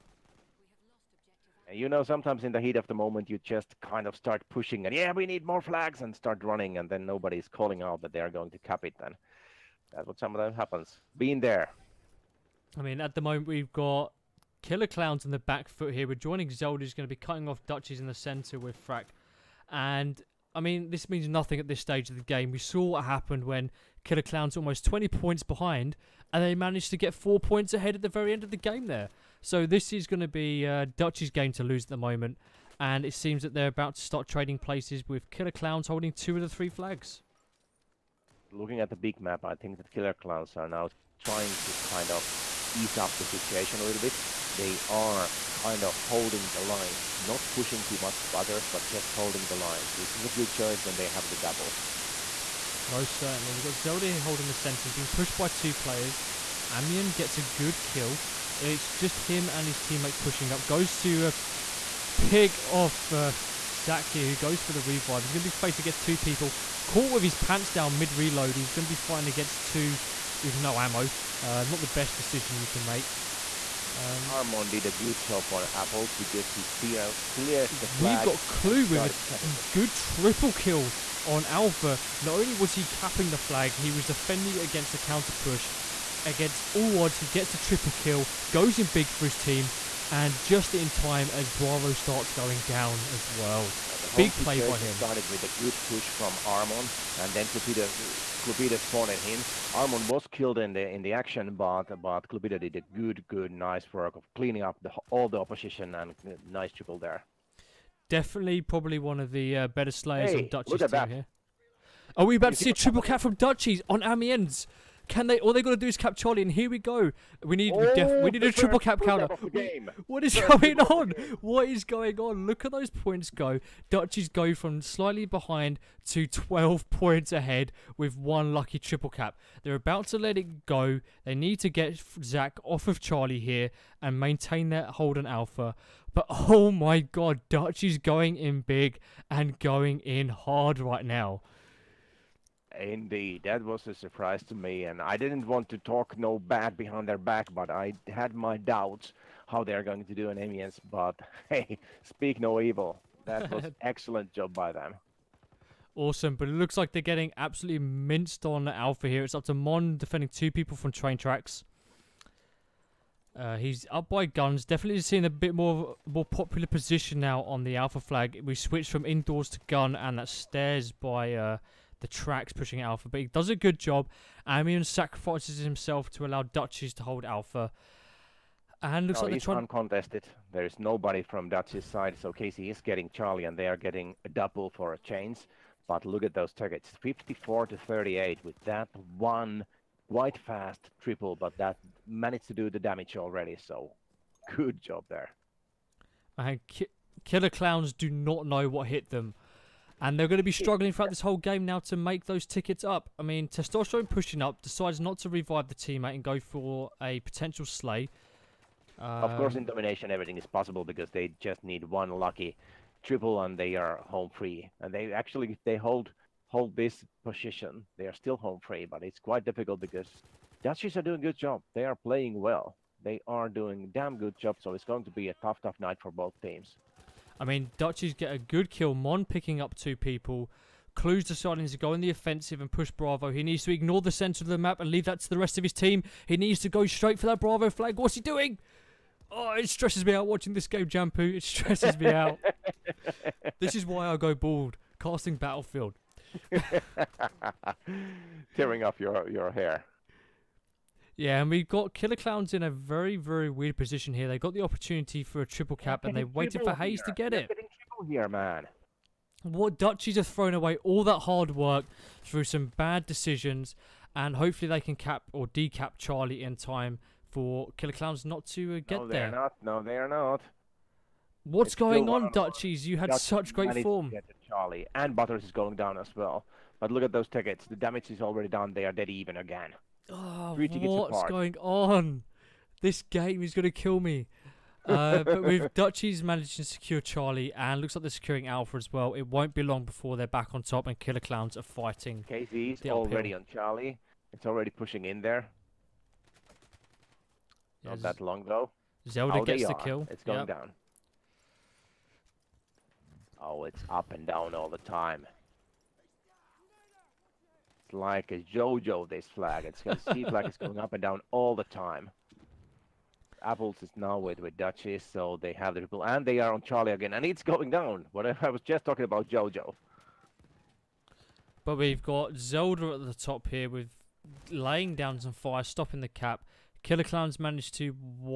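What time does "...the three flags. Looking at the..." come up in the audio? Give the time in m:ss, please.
0:36.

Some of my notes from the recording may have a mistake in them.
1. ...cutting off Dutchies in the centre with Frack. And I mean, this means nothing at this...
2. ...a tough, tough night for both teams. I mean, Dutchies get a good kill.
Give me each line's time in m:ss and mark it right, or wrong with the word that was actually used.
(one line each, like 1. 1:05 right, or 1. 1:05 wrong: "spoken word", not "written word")
1. 0:17 right
2. 3:45 right.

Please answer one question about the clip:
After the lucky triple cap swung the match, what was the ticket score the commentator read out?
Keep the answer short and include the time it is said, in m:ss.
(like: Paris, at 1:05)
54 to 38, at 3:07.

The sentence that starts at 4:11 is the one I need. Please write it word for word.
Yeah, and we've got Killer Clowns in a very, very weird position here.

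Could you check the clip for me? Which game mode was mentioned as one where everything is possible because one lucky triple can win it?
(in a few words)
Domination.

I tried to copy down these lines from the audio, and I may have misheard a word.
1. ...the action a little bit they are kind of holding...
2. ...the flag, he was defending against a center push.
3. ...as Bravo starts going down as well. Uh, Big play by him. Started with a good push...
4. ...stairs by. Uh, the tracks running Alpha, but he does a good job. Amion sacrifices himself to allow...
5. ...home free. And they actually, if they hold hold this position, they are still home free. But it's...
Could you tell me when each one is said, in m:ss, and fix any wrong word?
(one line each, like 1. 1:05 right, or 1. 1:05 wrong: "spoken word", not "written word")
1. 0:43 wrong: "situation", not "action"
2. 1:23 wrong: "counter", not "center"
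3. 1:31 right
4. 2:50 wrong: "pushing", not "running"
5. 3:34 right.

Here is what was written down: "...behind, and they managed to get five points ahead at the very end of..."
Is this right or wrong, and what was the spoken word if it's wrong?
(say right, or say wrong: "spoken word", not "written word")
wrong: "four", not "five".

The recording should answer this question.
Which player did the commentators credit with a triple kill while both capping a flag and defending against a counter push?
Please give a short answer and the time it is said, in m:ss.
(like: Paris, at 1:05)
Clue, at 1:18.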